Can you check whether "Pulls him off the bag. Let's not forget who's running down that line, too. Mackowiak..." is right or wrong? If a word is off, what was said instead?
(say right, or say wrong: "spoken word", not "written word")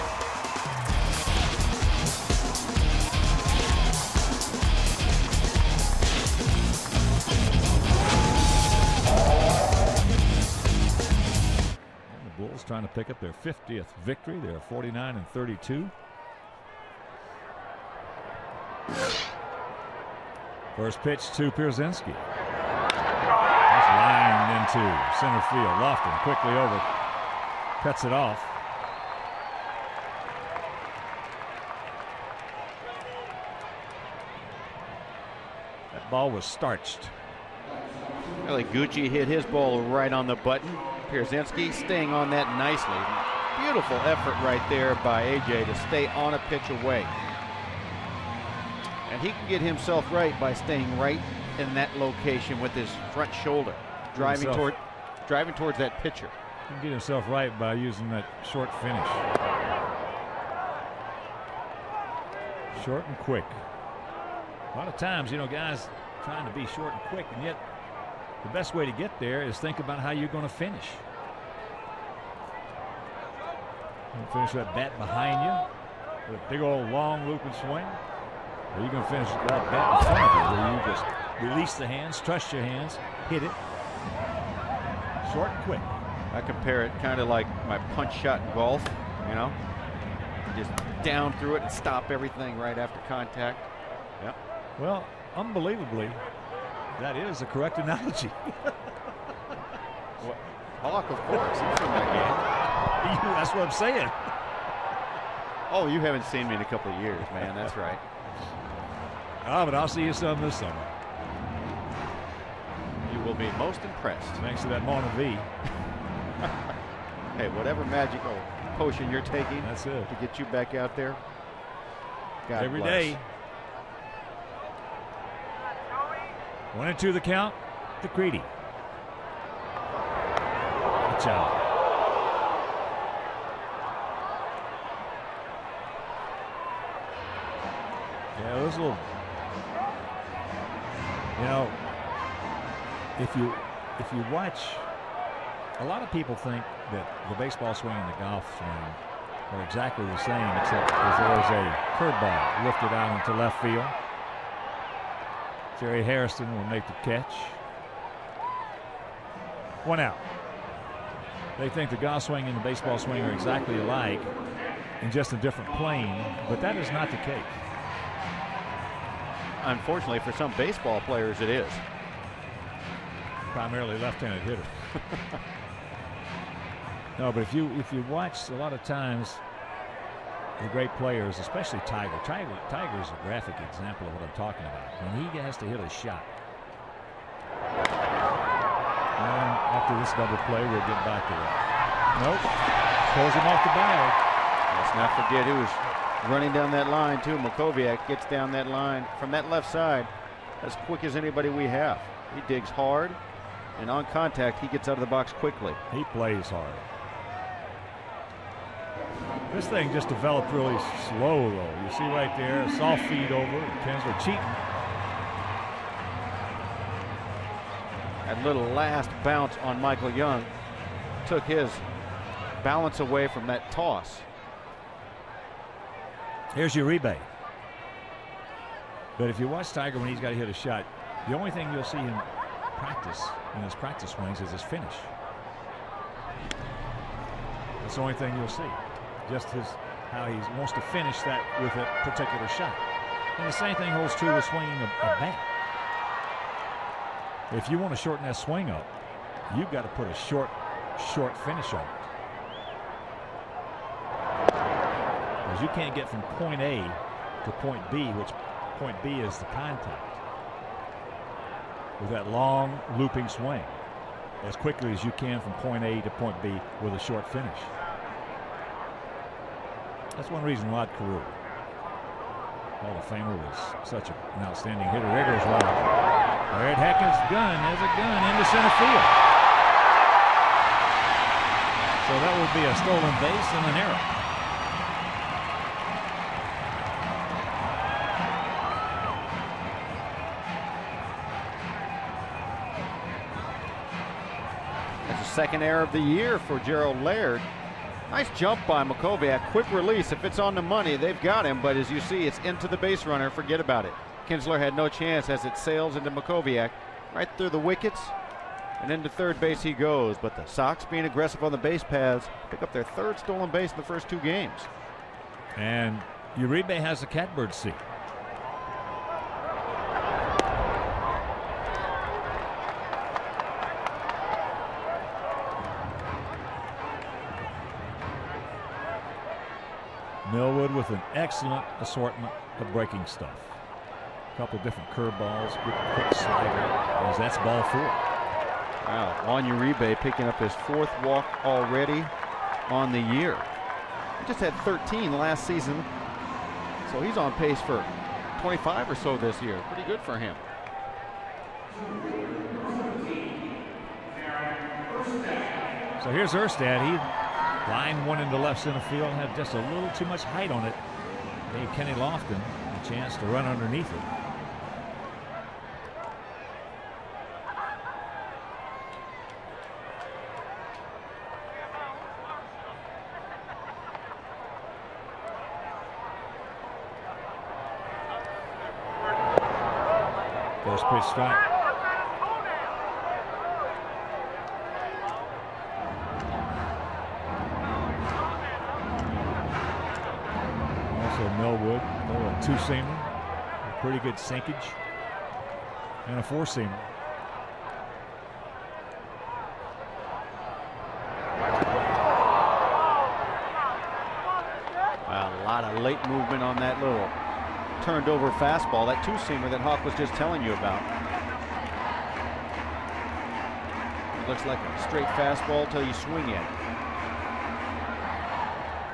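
right.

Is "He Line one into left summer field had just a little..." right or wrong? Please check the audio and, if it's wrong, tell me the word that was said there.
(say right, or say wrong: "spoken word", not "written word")
wrong: "center", not "summer".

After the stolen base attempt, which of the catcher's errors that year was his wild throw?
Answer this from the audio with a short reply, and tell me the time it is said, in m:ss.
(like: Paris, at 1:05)
Second, at 4:55.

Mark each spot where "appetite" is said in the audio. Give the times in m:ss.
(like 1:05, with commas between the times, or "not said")
not said.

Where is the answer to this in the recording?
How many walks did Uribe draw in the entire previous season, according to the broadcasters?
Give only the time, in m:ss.
5:44.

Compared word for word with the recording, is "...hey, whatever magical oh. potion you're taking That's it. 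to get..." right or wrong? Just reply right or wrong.
right.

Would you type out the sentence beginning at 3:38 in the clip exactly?
That little last bounce on Michael Young took his balance away from that toss.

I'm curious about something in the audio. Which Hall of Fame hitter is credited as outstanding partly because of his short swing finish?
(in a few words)
Rod Carew.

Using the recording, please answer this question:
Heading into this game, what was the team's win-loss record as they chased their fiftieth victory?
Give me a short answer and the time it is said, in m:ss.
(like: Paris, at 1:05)
49-32, at 0:14.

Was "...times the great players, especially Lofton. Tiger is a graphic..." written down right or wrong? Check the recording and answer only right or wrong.
wrong.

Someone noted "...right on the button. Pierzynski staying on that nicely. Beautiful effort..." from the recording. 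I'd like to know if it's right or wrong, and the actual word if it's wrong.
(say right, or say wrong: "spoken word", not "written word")
right.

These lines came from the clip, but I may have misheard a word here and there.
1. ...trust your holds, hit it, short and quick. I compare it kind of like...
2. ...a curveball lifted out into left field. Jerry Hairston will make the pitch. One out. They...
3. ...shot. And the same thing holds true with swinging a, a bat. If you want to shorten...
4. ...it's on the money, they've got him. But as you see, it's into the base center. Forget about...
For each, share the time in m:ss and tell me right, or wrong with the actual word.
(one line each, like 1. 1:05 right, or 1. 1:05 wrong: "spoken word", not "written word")
1. 1:22 wrong: "hands", not "holds"
2. 2:31 wrong: "catch", not "pitch"
3. 4:02 right
4. 5:00 wrong: "runner", not "center".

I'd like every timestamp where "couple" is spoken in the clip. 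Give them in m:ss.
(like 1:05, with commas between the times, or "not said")
1:46, 5:34.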